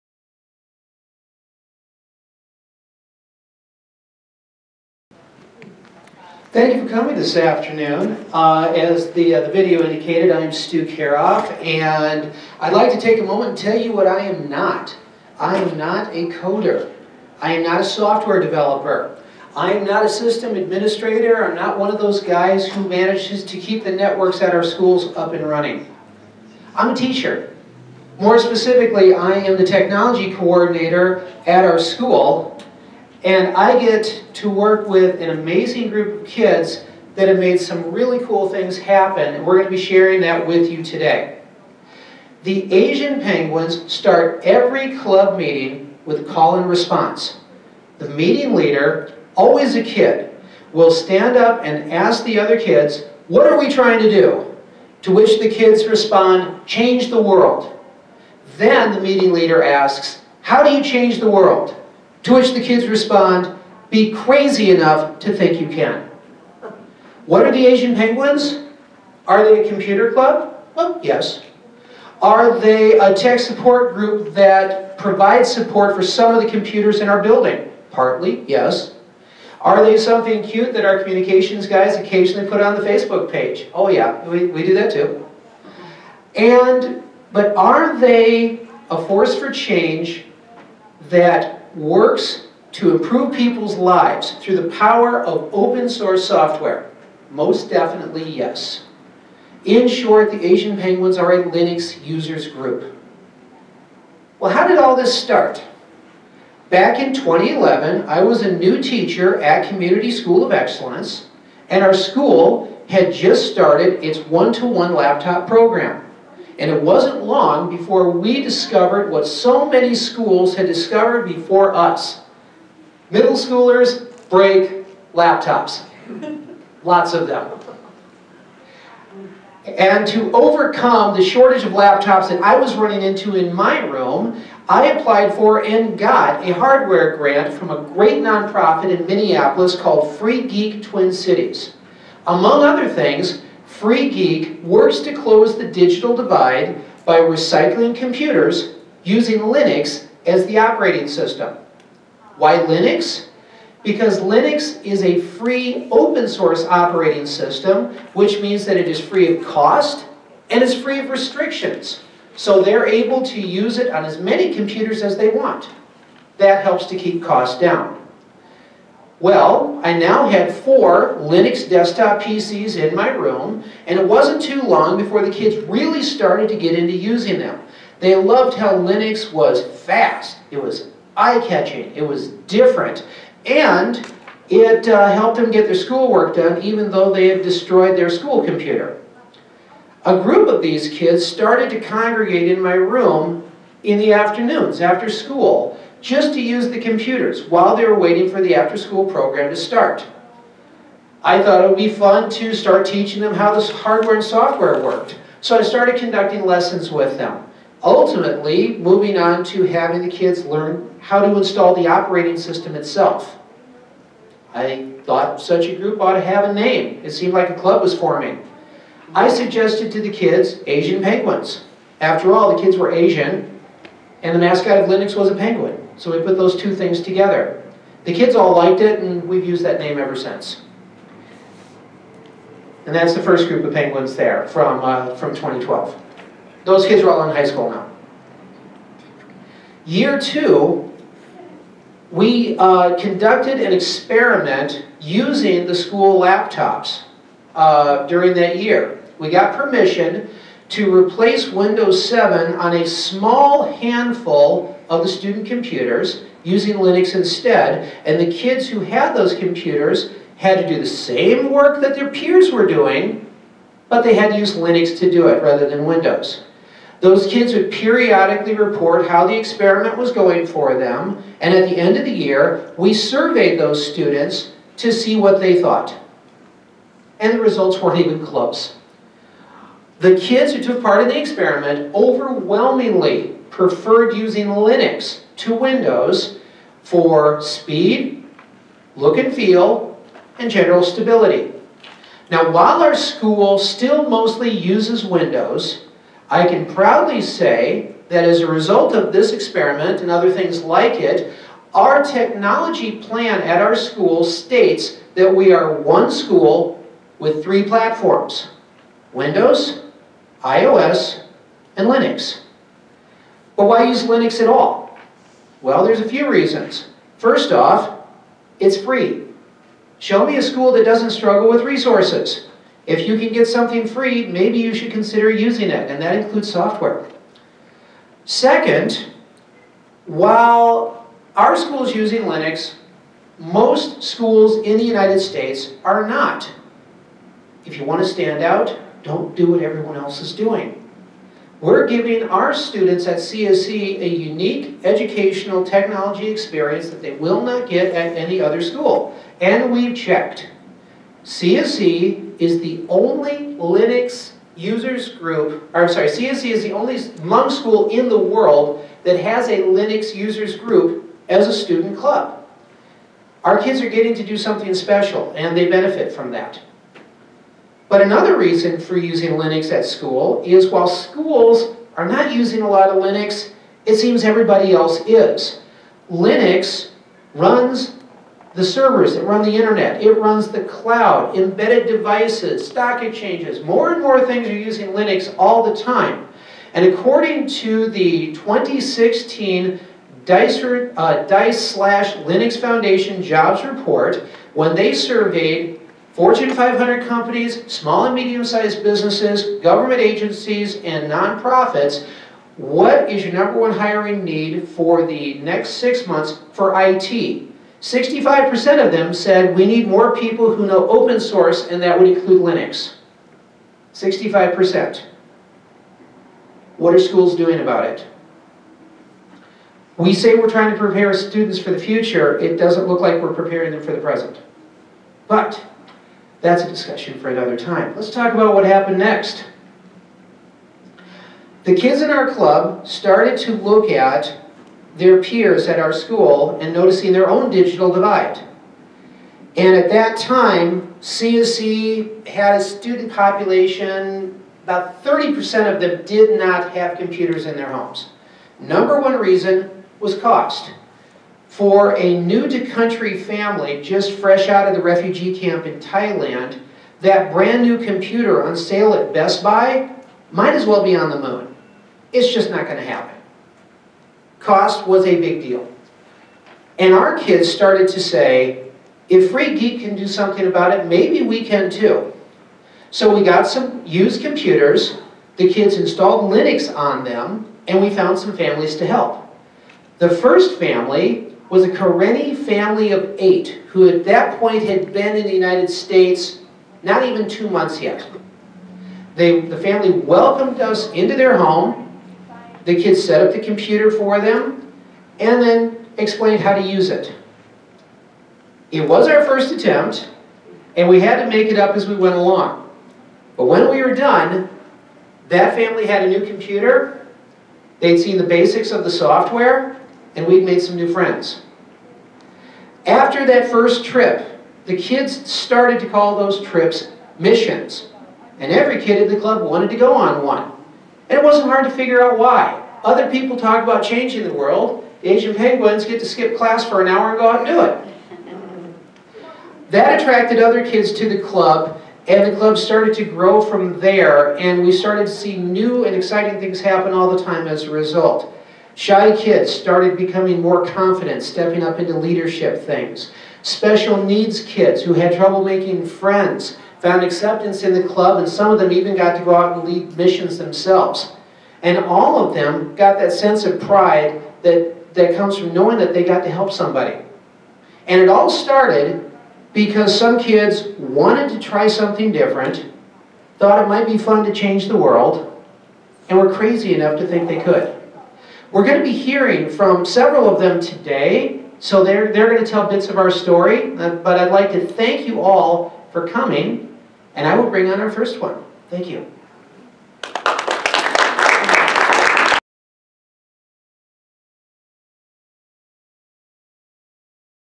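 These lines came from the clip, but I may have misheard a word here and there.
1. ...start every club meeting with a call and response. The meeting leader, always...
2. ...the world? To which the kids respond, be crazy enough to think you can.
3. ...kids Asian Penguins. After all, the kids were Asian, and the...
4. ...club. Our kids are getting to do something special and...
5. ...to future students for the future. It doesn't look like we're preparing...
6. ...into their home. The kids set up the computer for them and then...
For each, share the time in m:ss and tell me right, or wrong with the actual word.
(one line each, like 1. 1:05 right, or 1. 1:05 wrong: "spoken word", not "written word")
1. 0:43 right
2. 1:01 right
3. 3:40 right
4. 6:01 right
5. 7:00 wrong: "prepare", not "future"
6. 8:10 right.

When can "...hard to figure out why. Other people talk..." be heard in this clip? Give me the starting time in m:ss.
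8:41.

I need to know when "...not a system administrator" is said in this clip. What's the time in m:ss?
0:19.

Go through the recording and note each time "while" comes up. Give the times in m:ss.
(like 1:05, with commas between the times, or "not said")
3:17, 4:52, 5:30, 6:10.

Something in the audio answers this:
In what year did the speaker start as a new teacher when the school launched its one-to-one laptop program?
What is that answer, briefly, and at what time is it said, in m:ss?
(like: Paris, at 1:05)
2011, at 1:47.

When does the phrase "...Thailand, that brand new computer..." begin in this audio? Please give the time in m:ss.
7:35.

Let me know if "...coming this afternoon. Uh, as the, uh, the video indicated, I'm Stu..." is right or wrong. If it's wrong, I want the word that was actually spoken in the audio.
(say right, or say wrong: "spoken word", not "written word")
right.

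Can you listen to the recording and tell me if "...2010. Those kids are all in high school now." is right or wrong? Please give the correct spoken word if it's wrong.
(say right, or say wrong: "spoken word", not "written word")
wrong: "2012", not "2010".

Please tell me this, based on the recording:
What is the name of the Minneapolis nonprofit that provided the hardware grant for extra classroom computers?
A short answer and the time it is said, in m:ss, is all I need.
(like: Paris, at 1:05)
Free Geek Twin Cities, at 2:20.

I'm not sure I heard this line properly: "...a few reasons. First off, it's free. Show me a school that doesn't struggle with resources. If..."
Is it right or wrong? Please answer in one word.
right.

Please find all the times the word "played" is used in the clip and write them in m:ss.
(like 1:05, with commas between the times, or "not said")
not said.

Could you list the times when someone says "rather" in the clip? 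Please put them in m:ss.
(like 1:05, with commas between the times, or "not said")
4:25.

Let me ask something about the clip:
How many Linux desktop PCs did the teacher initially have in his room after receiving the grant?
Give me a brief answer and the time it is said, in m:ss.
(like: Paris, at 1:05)
4, at 2:50.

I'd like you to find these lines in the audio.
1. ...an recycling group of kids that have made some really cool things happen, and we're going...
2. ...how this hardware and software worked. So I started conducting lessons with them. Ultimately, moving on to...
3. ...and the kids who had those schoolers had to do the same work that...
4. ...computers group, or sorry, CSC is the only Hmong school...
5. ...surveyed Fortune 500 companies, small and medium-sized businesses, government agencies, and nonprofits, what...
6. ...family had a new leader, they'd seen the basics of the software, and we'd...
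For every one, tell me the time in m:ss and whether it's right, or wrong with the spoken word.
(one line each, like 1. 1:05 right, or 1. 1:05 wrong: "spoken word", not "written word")
1. 0:35 wrong: "amazing", not "recycling"
2. 3:23 right
3. 4:18 wrong: "computers", not "schoolers"
4. 5:54 wrong: "users", not "computers"
5. 6:34 right
6. 8:25 wrong: "computer", not "leader".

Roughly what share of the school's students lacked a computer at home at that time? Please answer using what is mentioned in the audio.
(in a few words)
30%.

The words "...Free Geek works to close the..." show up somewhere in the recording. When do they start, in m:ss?
2:23.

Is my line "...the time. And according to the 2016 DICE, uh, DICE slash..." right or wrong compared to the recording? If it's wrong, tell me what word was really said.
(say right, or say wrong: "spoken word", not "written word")
right.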